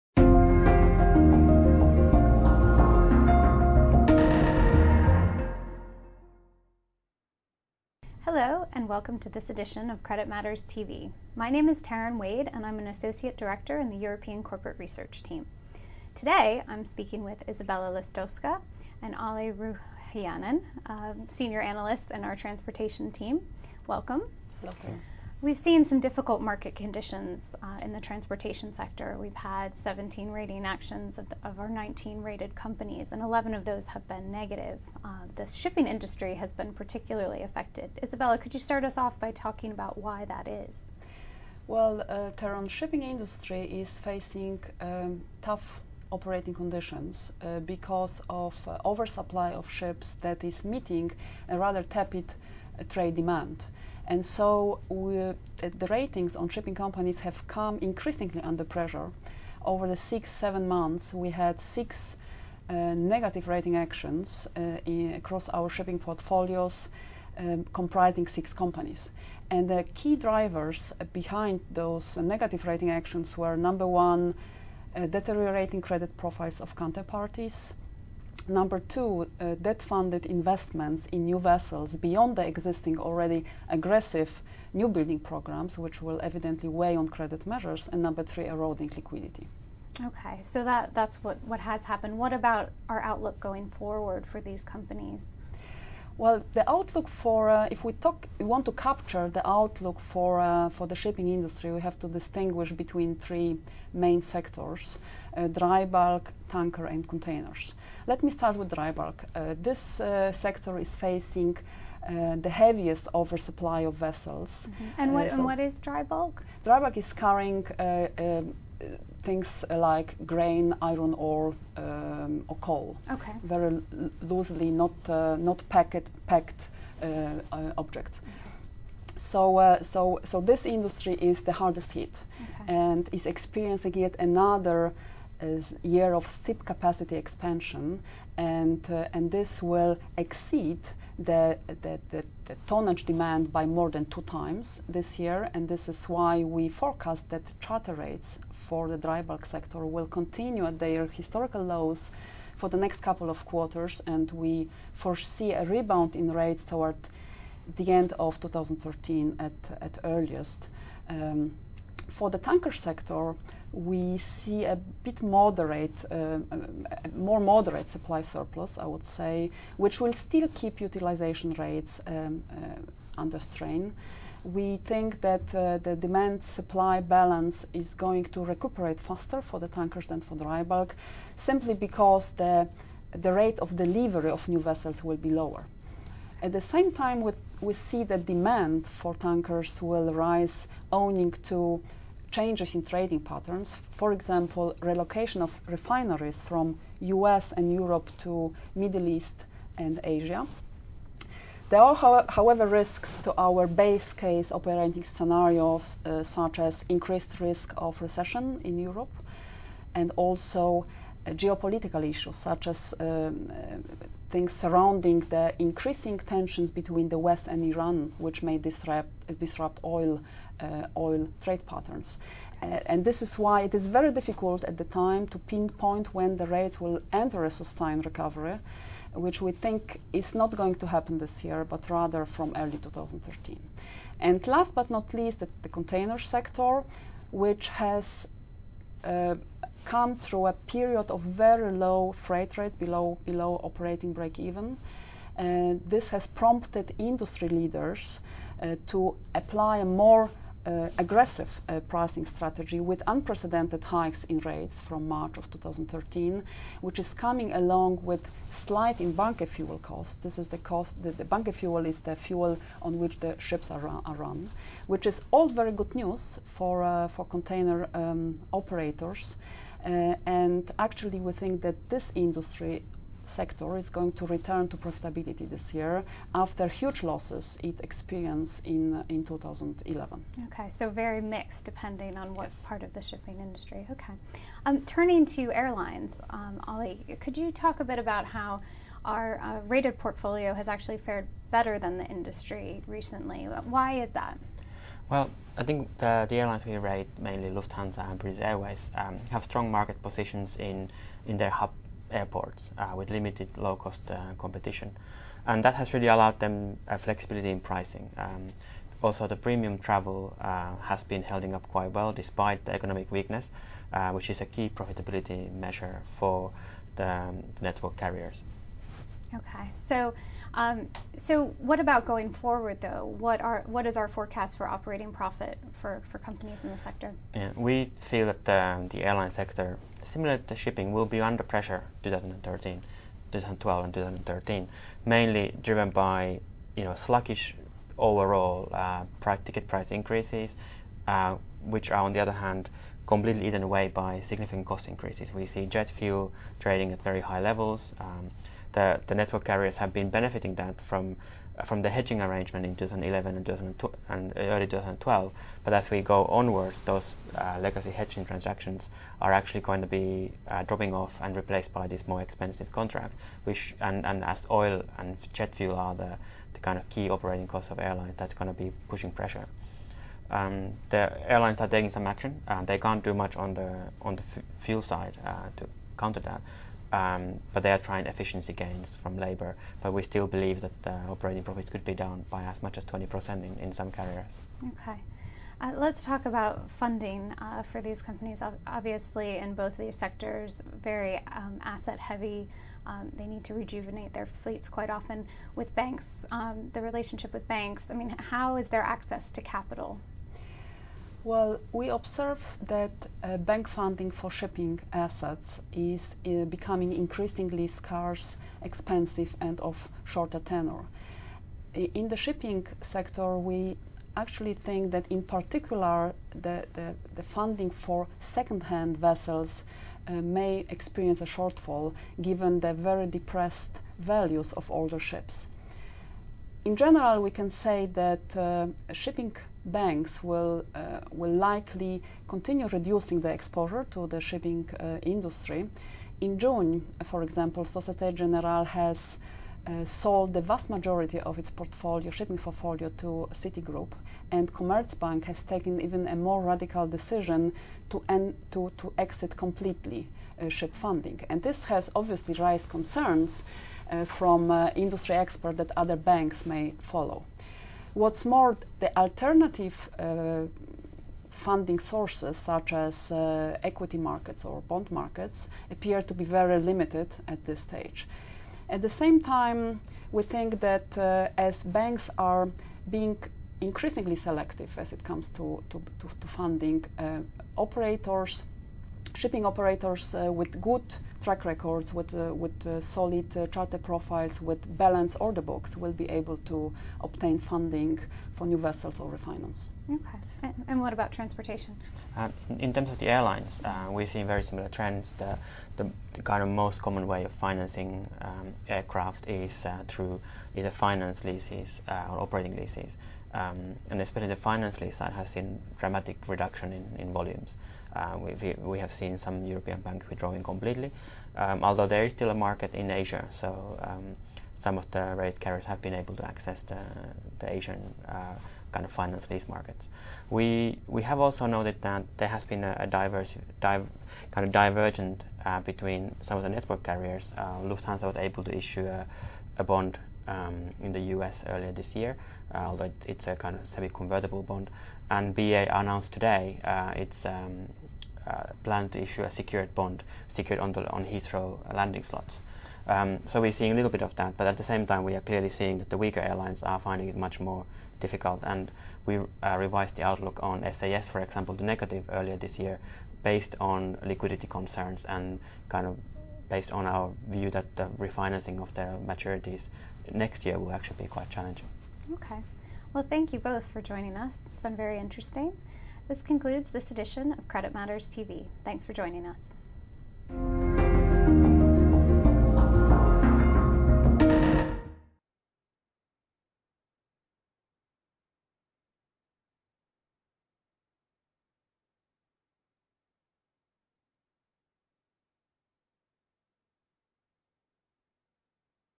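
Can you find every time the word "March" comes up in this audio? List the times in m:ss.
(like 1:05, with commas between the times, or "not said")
4:15.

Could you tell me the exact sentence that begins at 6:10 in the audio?
Um, the airlines are taking some action.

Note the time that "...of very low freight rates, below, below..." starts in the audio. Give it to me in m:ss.
4:01.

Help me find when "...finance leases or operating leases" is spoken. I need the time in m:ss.
8:20.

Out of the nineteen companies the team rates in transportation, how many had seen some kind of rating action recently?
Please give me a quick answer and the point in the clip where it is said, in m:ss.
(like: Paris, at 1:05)
17, at 0:29.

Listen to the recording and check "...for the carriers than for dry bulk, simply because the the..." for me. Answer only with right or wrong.
wrong.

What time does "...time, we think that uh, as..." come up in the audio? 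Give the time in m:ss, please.
7:49.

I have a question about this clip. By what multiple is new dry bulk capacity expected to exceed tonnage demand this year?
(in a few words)
more than 2 times.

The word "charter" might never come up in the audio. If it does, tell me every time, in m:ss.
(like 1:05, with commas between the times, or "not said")
2:27, 8:03.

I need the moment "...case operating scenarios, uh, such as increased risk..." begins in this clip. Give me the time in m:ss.
3:24.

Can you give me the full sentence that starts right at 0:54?
And so the ratings on shipping companies have come increasingly under pressure.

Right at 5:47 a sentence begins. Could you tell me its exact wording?
Um, the, the network carriers have been benefiting that from uh, from the hedging arrangement in 2011 and, 2012 and early 2012.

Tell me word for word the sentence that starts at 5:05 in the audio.
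And that has really allowed them uh, flexibility in pricing.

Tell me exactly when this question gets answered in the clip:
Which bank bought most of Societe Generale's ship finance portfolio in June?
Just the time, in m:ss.
7:23.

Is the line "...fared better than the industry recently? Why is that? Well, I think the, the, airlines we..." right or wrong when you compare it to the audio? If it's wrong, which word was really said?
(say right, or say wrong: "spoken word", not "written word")
right.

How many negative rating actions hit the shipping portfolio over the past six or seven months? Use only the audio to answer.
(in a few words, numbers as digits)
6.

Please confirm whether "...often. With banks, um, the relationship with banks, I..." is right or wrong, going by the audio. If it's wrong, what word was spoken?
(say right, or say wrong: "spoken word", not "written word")
right.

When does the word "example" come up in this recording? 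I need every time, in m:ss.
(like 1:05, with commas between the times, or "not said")
3:14, 7:17, 9:11.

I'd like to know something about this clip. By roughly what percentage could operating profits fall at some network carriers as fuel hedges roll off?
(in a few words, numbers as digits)
20%.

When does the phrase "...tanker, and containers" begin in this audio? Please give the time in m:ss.
1:46.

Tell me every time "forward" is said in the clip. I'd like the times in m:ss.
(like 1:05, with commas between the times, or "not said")
1:33, 5:22.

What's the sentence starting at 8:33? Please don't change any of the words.
So um, some of the rate carriers have been able to access the, the Asian uh, kind of finance lease markets.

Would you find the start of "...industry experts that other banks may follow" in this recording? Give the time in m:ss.
7:34.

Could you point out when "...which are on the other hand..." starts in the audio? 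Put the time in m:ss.
5:41.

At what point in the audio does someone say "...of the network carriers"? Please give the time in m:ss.
8:46.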